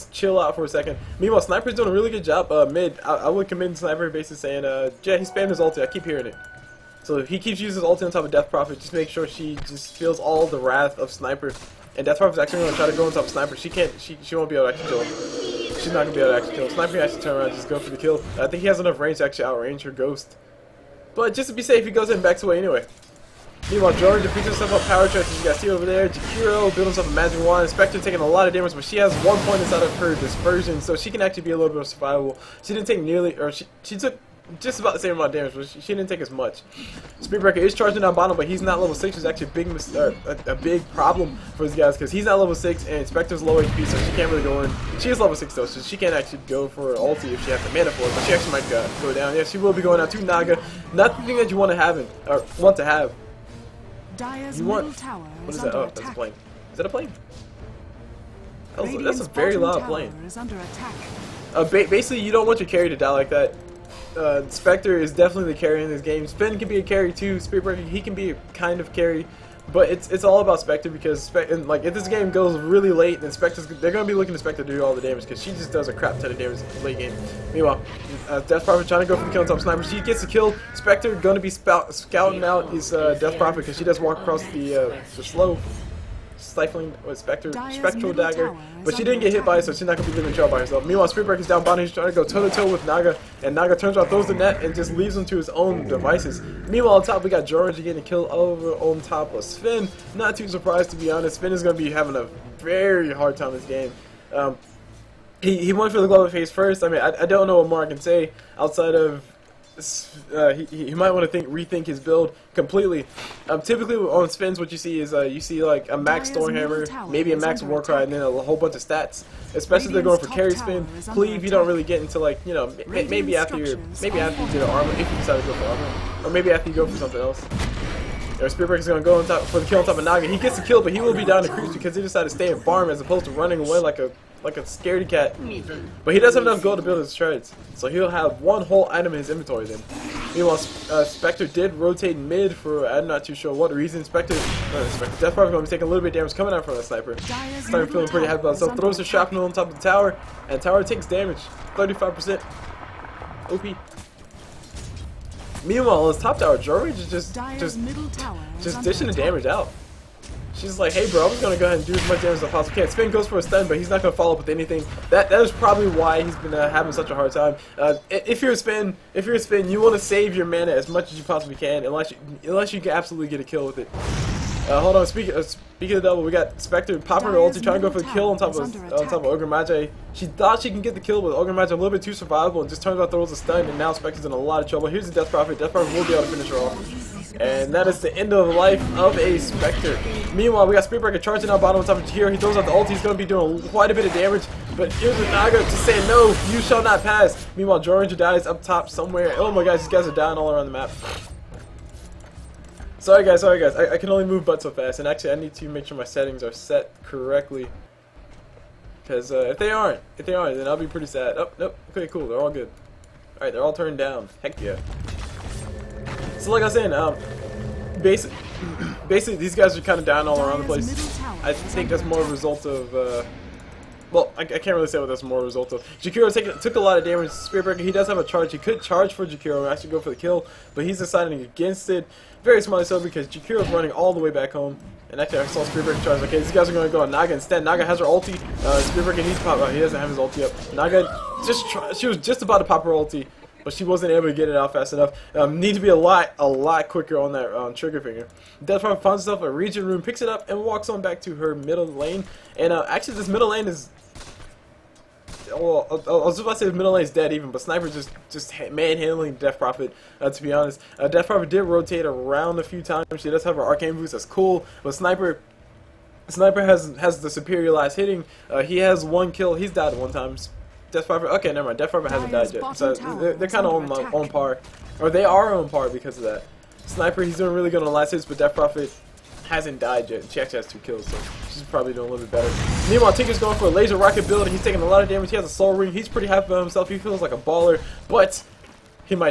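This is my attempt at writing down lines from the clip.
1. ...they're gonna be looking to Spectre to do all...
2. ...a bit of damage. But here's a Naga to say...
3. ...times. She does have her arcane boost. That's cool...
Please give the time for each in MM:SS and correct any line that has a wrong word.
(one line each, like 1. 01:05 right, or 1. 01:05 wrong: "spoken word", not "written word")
1. 01:13 right
2. 03:13 right
3. 04:22 right.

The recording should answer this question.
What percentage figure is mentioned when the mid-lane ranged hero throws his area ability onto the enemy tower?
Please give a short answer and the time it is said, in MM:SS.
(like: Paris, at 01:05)
35%, at 02:31.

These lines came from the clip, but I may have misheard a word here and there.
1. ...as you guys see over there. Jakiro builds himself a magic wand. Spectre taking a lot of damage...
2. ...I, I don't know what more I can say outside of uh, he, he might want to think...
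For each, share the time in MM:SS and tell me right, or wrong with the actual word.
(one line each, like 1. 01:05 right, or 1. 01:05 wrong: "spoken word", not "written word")
1. 00:25 right
2. 01:47 right.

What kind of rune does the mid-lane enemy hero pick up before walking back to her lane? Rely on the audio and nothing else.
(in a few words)
Regen rune.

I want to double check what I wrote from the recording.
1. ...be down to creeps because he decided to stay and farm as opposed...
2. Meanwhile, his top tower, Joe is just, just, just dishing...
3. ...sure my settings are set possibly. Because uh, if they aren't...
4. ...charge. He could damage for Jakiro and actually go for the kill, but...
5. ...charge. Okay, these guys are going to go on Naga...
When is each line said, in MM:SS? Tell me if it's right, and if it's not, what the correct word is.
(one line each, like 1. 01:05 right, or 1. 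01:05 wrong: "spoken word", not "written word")
1. 02:11 right
2. 02:35 right
3. 03:25 wrong: "correctly", not "possibly"
4. 03:48 wrong: "charge", not "damage"
5. 03:56 right.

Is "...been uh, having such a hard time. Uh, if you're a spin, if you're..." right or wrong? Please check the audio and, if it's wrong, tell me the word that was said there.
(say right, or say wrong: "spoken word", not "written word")
right.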